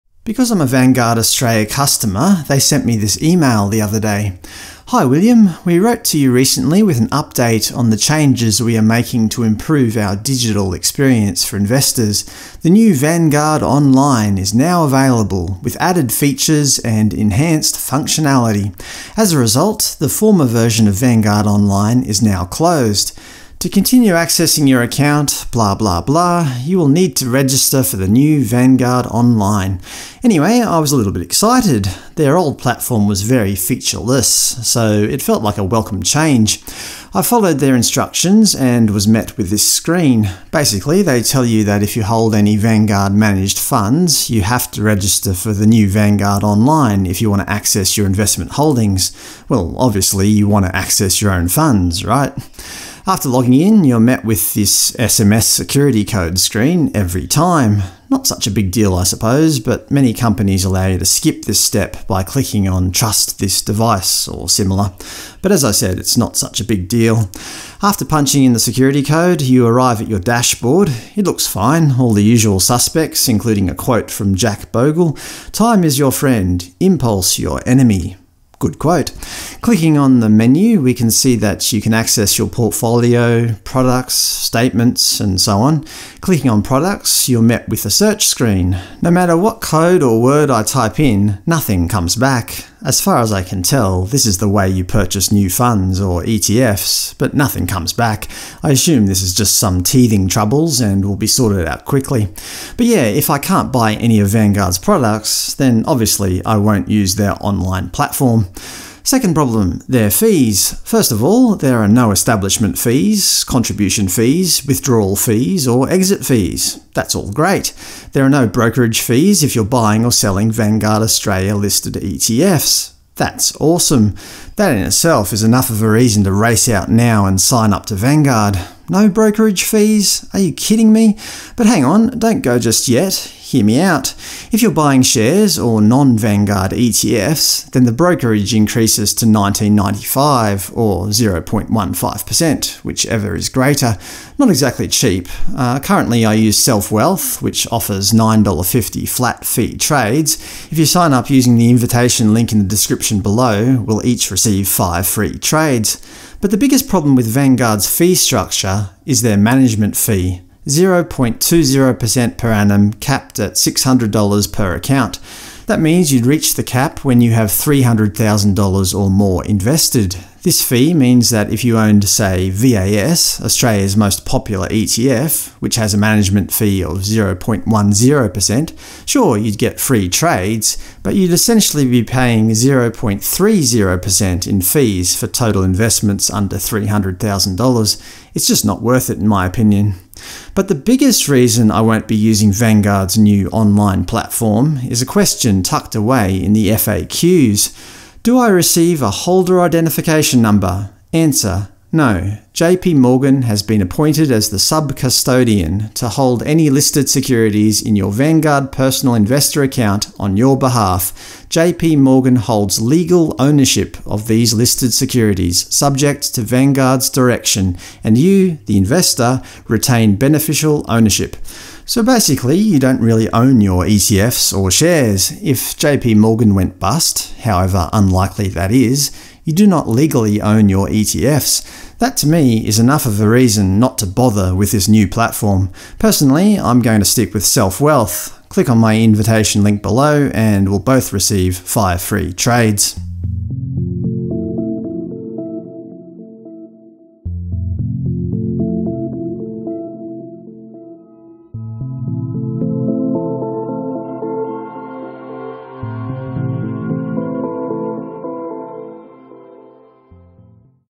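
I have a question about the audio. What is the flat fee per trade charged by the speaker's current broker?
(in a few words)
$9.50.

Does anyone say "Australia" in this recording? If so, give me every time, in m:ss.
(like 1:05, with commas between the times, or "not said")
0:01, 2:01, 2:53.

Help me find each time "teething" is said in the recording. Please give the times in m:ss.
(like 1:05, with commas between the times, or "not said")
1:39.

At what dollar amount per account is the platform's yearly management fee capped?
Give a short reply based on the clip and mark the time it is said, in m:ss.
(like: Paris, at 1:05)
$600, at 2:43.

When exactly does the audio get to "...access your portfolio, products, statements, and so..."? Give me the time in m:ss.
1:21.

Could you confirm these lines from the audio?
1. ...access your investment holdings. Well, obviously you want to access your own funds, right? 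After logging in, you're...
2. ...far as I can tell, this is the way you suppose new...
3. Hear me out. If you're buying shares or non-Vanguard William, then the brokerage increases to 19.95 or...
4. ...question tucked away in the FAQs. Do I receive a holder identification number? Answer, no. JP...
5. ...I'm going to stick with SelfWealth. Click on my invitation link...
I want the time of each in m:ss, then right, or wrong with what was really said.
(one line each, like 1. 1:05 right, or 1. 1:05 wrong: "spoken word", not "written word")
1. 0:47 right
2. 1:32 wrong: "purchase", not "suppose"
3. 2:13 wrong: "ETFs", not "William"
4. 3:15 right
5. 3:56 right.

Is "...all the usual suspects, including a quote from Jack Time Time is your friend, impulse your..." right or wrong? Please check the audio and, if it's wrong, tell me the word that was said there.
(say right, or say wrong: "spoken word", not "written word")
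wrong: "Bogle", not "Time".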